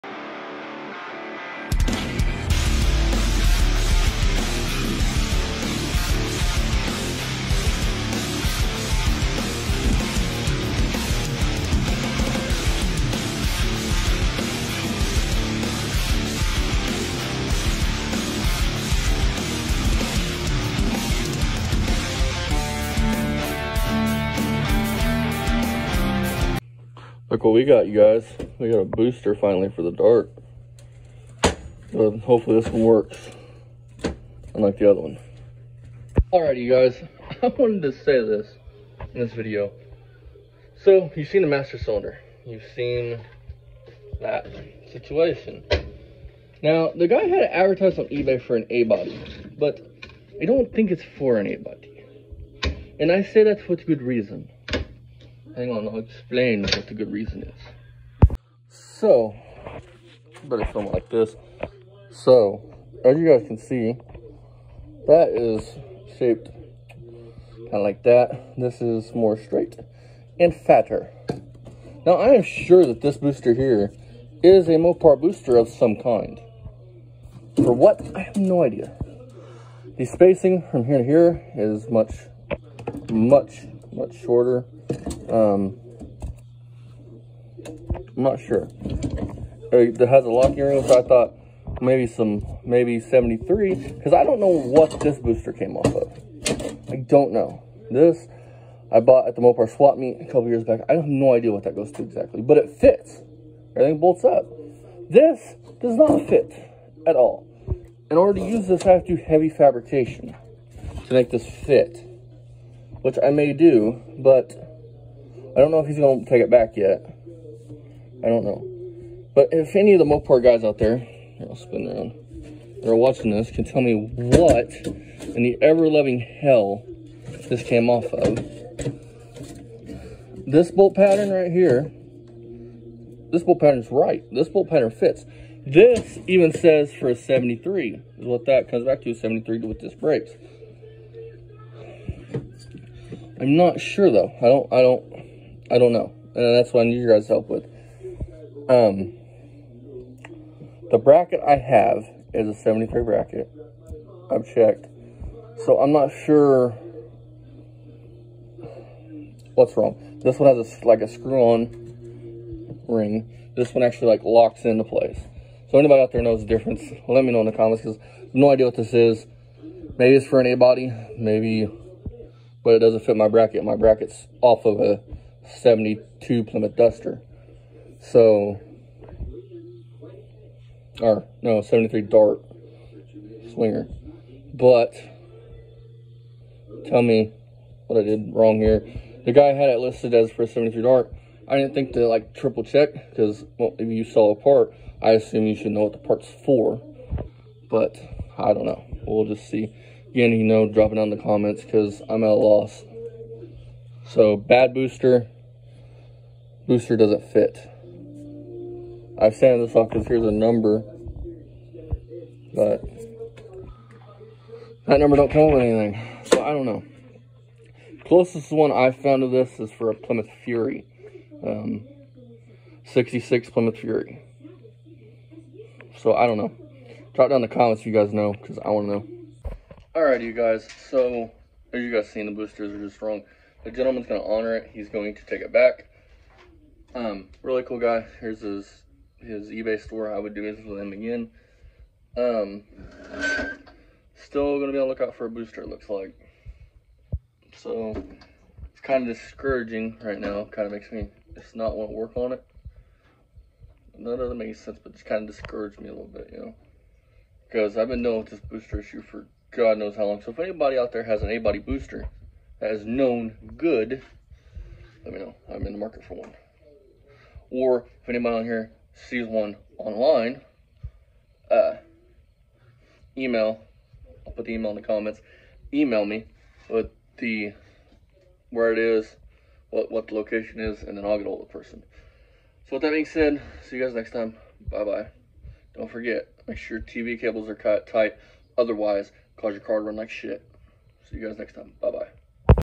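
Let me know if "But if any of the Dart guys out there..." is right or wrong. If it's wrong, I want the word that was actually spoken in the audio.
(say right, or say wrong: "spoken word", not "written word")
wrong: "Mopar", not "Dart".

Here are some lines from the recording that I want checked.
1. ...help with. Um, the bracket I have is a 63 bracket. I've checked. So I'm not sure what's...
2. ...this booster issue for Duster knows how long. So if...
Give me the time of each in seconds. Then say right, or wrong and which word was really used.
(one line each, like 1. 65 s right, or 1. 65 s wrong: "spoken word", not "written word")
1. 147 s wrong: "73", not "63"
2. 258 s wrong: "God", not "Duster".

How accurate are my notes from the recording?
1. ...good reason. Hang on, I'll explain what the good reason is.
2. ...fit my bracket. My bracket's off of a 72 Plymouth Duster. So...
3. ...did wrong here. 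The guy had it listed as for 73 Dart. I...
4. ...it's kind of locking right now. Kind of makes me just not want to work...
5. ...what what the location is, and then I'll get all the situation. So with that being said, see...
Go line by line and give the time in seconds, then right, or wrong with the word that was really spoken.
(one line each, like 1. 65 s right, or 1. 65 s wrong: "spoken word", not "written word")
1. 53 s right
2. 173 s right
3. 188 s right
4. 248 s wrong: "discouraging", not "locking"
5. 279 s wrong: "person", not "situation".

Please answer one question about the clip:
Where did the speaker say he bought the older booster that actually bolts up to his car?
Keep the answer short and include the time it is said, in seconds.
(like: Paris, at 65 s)
Mopar swap meet, at 99 s.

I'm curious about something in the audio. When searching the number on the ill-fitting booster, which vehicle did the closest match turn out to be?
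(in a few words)
1966 Plymouth Fury.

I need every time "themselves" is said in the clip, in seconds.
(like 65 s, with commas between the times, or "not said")
not said.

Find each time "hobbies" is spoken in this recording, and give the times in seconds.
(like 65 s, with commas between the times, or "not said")
not said.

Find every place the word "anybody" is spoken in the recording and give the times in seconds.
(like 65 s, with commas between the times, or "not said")
165 s, 260 s, 268 s.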